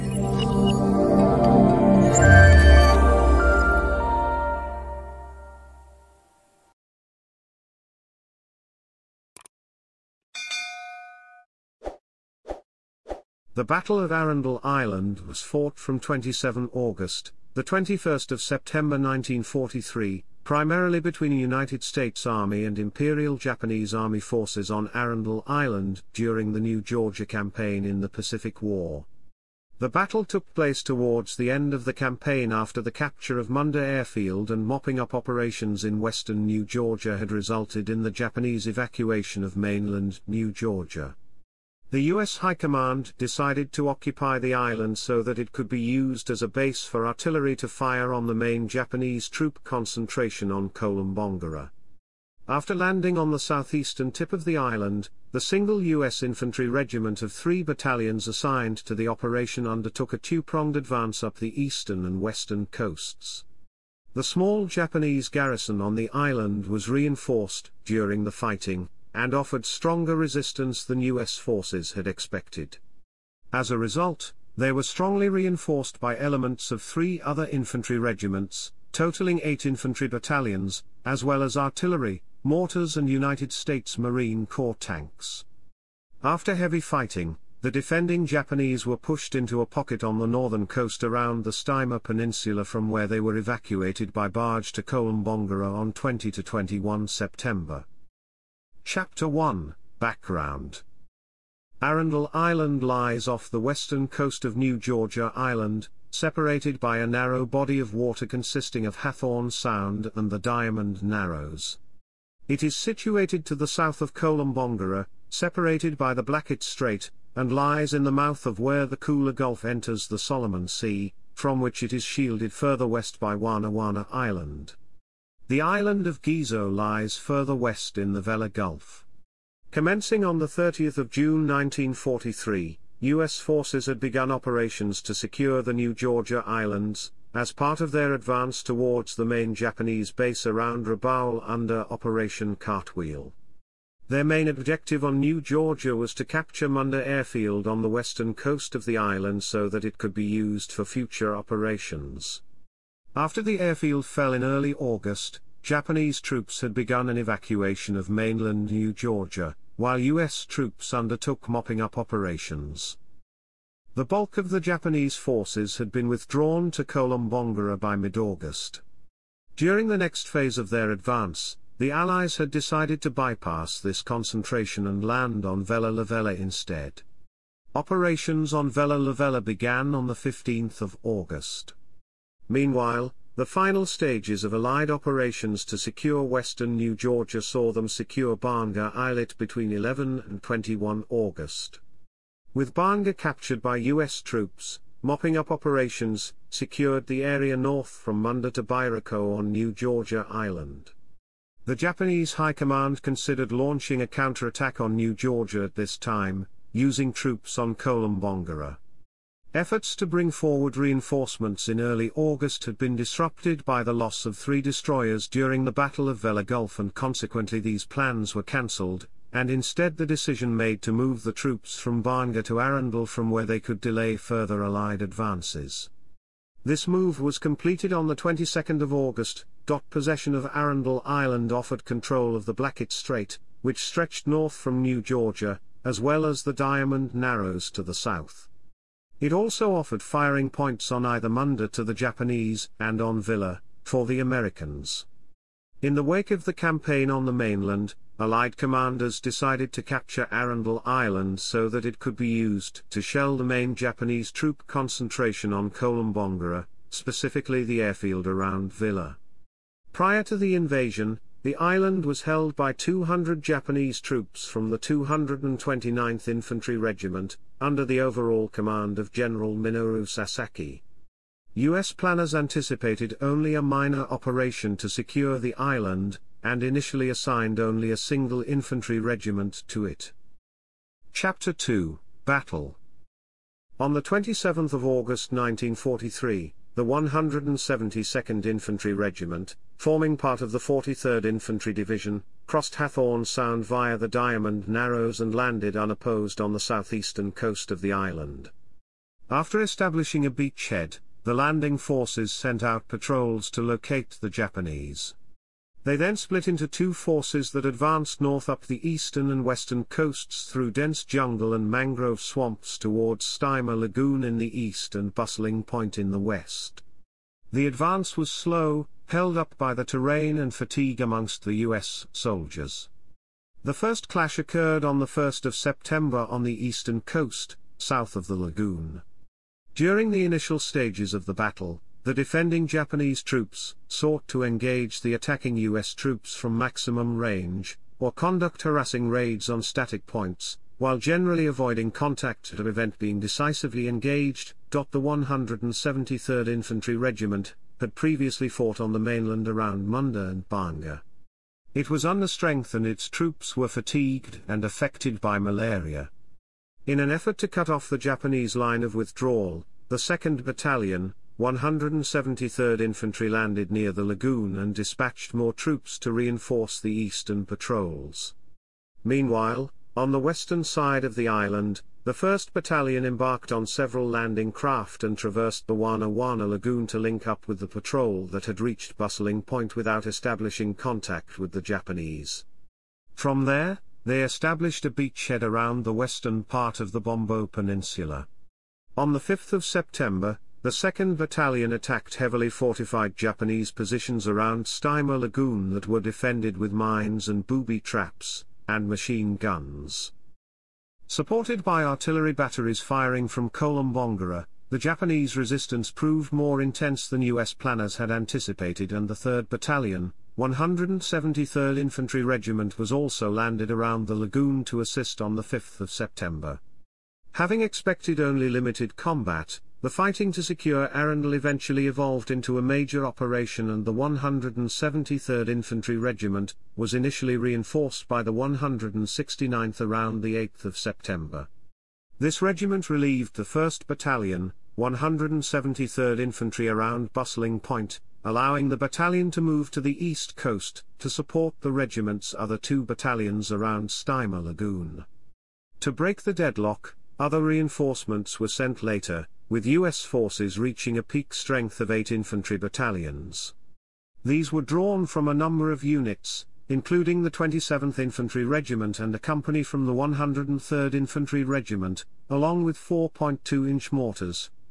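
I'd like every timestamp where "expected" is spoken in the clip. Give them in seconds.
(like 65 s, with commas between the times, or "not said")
72 s, 417 s.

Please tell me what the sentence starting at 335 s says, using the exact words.
troops from maximum range, or conduct harassing raids on static points, while generally avoiding contact to prevent being decisively engaged.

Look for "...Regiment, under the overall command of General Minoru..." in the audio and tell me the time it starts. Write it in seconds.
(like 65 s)
266 s.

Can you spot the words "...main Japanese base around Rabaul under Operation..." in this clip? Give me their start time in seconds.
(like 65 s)
139 s.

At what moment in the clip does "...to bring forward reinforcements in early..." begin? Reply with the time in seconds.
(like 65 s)
209 s.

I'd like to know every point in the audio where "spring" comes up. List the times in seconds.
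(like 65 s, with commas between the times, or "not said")
not said.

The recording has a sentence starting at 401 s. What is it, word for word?
Supported by artillery batteries firing from Kolombangara, the Japanese resistance proved more intense than U.S.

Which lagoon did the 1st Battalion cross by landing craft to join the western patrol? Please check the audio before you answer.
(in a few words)
Wana Wana Lagoon.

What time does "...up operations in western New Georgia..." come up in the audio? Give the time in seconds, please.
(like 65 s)
34 s.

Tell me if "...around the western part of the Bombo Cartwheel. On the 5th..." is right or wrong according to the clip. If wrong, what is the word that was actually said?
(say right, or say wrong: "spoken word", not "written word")
wrong: "Peninsula", not "Cartwheel".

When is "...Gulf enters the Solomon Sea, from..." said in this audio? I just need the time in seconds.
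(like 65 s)
119 s.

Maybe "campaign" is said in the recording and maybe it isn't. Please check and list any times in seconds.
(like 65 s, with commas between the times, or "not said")
27 s, 31 s, 246 s.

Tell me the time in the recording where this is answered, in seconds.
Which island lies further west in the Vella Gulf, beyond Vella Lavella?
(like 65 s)
126 s.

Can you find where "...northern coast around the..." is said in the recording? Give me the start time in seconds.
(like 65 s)
90 s.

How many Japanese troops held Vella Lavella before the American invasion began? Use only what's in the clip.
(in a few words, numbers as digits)
200.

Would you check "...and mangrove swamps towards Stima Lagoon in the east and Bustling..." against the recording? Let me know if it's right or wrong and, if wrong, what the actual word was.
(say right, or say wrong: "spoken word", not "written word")
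right.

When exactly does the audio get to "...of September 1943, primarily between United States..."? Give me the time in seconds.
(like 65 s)
18 s.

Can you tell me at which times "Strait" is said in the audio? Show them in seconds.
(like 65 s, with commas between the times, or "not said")
116 s, 232 s.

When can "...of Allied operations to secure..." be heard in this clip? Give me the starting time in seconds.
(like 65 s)
184 s.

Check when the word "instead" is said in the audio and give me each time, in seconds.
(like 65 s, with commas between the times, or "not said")
176 s, 219 s.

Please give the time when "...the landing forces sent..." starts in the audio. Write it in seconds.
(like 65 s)
301 s.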